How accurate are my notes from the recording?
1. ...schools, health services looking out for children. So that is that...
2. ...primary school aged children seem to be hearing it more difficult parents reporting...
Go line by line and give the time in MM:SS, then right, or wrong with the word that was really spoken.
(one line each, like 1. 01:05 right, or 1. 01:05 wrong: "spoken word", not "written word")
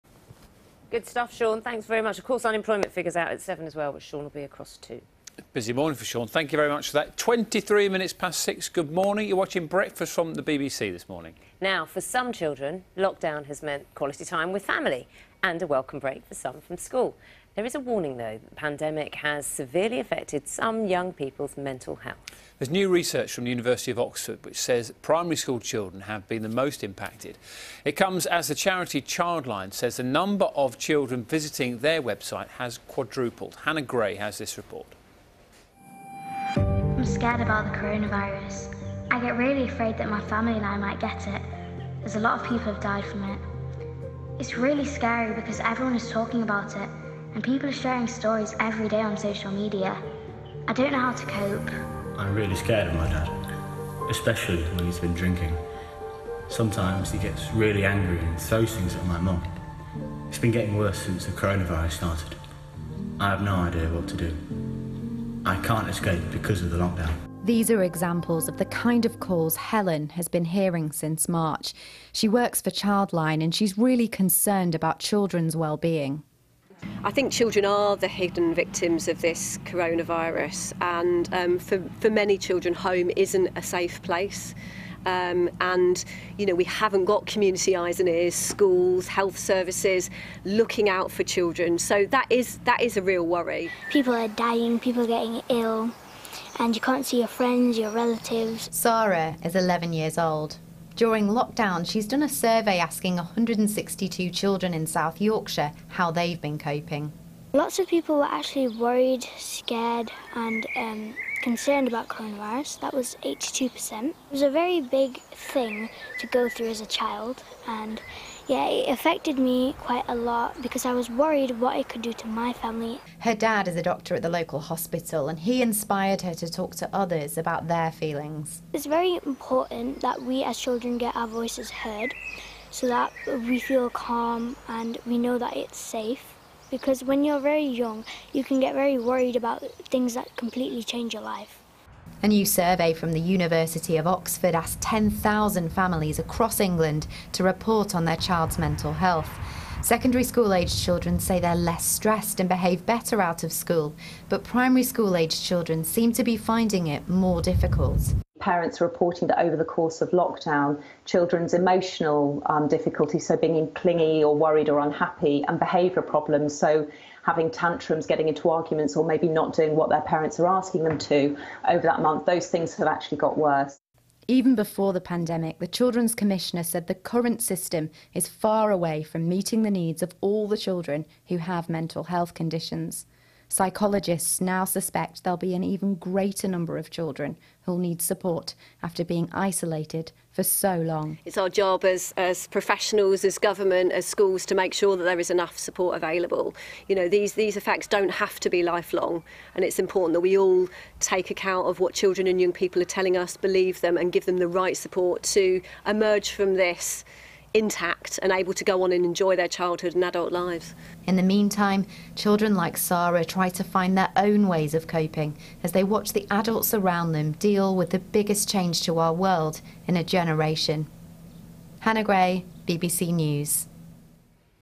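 1. 01:28 right
2. 02:34 wrong: "finding", not "hearing".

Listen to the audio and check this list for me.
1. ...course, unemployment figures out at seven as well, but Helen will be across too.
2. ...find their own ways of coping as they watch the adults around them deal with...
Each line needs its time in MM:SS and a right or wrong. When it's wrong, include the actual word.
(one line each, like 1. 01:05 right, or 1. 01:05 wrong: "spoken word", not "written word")
1. 00:02 wrong: "Sean", not "Helen"
2. 03:33 right.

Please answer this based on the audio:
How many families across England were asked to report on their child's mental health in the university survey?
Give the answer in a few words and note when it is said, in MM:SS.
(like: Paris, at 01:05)
10,000, at 02:24.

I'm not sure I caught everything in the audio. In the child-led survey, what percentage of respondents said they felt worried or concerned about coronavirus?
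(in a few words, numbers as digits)
82%.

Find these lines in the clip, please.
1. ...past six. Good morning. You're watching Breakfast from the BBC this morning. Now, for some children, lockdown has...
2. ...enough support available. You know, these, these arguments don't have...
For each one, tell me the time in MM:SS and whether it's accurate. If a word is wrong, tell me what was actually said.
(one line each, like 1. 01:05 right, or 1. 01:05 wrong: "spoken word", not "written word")
1. 00:08 right
2. 03:15 wrong: "effects", not "arguments".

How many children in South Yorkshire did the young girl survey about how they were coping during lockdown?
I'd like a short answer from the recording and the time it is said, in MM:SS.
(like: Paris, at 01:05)
162, at 01:43.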